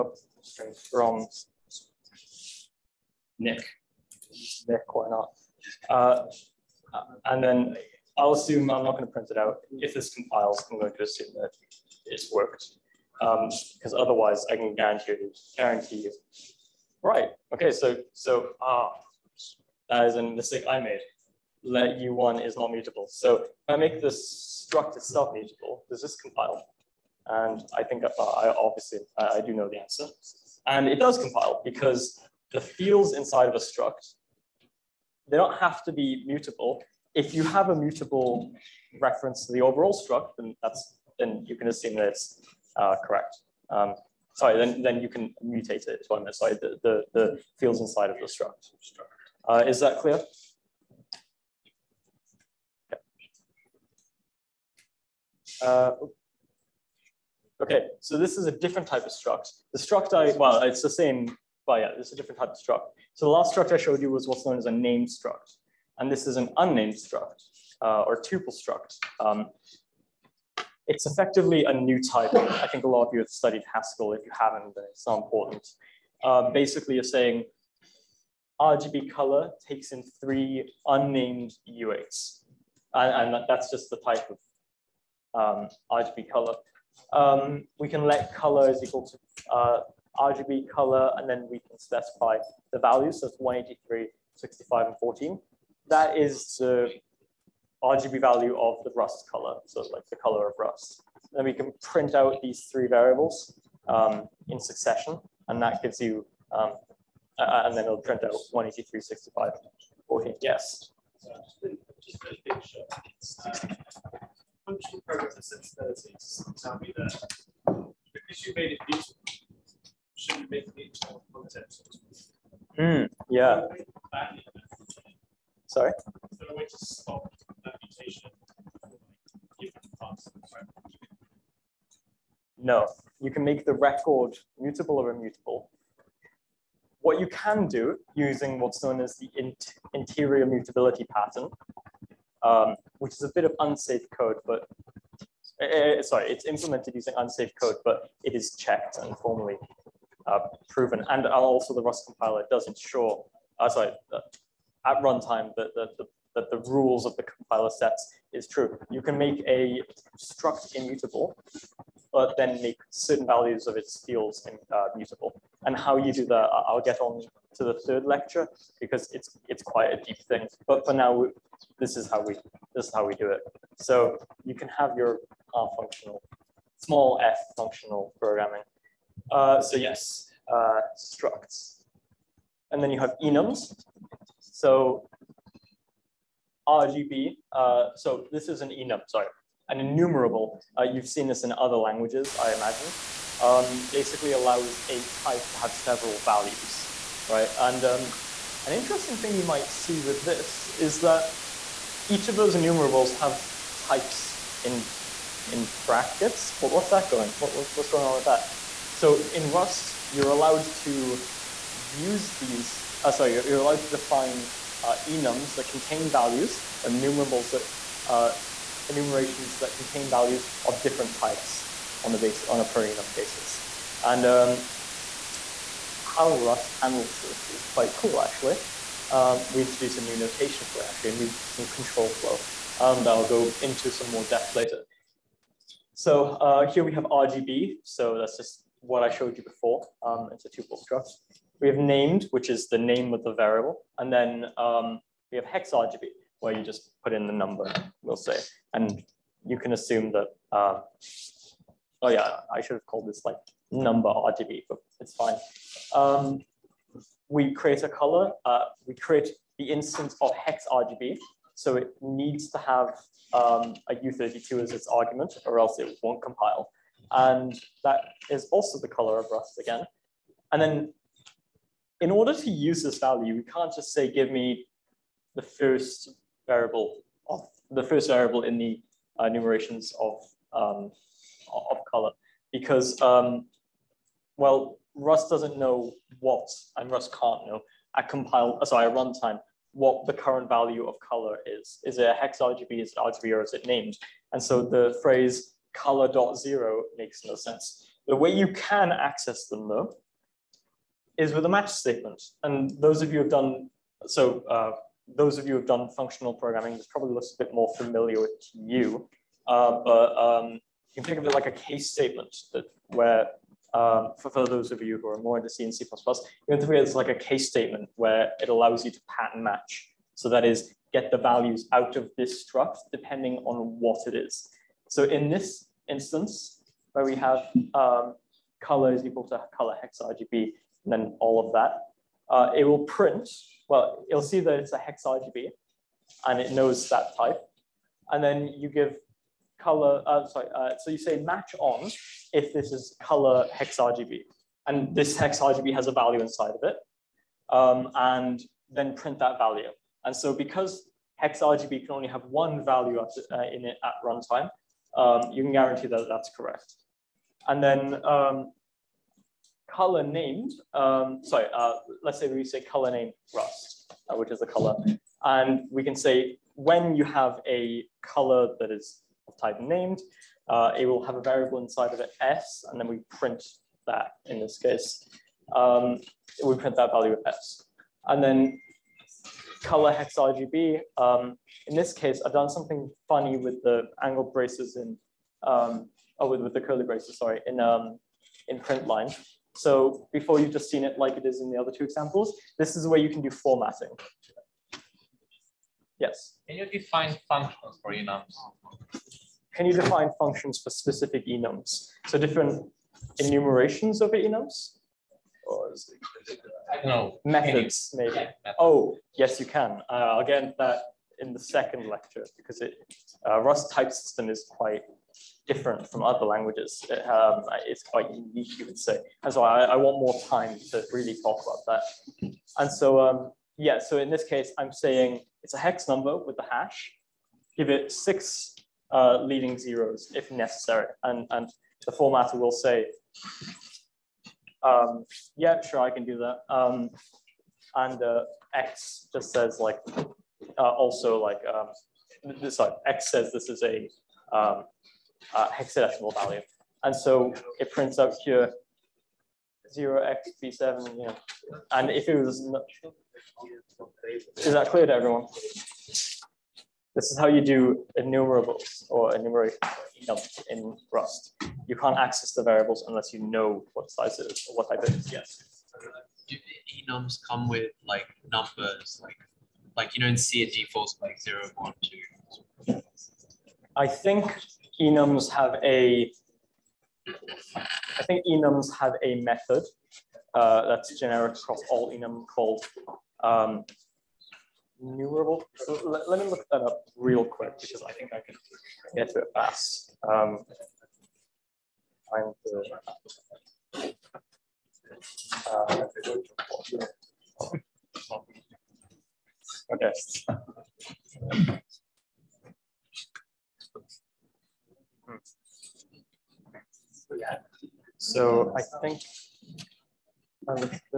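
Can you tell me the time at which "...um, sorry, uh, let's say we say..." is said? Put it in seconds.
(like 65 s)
360 s.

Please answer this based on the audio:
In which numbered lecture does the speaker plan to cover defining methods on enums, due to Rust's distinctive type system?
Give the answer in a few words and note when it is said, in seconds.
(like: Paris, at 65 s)
second, at 411 s.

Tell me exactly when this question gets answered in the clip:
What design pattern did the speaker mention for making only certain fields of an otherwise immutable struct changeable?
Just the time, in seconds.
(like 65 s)
139 s.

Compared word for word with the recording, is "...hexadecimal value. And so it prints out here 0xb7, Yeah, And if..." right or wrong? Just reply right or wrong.
right.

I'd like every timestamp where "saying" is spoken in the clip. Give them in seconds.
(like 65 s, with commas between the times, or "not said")
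77 s, 424 s.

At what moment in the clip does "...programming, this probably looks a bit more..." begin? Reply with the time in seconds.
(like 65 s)
306 s.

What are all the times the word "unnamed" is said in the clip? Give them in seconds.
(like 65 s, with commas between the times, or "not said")
66 s, 80 s.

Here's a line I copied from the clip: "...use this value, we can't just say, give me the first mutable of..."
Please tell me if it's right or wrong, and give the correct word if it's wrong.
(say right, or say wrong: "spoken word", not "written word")
wrong: "variable", not "mutable".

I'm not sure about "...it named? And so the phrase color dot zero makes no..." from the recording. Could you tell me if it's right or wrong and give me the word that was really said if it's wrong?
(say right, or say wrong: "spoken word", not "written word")
right.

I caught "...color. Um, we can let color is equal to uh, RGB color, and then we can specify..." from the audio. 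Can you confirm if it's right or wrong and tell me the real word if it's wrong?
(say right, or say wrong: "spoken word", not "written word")
right.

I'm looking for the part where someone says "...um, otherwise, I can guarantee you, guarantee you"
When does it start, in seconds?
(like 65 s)
13 s.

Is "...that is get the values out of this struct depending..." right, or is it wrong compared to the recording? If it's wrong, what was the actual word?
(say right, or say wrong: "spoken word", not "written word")
right.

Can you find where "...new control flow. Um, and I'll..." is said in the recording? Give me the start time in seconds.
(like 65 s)
231 s.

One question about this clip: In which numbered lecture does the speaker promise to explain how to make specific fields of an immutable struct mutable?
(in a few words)
third.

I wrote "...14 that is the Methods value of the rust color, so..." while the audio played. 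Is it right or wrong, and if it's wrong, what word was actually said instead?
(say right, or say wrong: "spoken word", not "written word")
wrong: "RGB", not "Methods".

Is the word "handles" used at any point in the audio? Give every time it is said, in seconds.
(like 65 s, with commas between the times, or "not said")
226 s.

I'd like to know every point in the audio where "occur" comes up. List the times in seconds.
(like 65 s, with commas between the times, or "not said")
not said.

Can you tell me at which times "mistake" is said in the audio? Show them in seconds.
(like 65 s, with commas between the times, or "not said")
20 s.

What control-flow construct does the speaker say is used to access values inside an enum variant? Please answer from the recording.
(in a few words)
match statement.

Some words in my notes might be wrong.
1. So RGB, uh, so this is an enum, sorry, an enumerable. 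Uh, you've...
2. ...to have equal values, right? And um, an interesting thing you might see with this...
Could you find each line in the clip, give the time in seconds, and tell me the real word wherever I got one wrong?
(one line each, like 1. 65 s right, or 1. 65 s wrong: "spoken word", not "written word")
1. 184 s right
2. 195 s wrong: "several", not "equal".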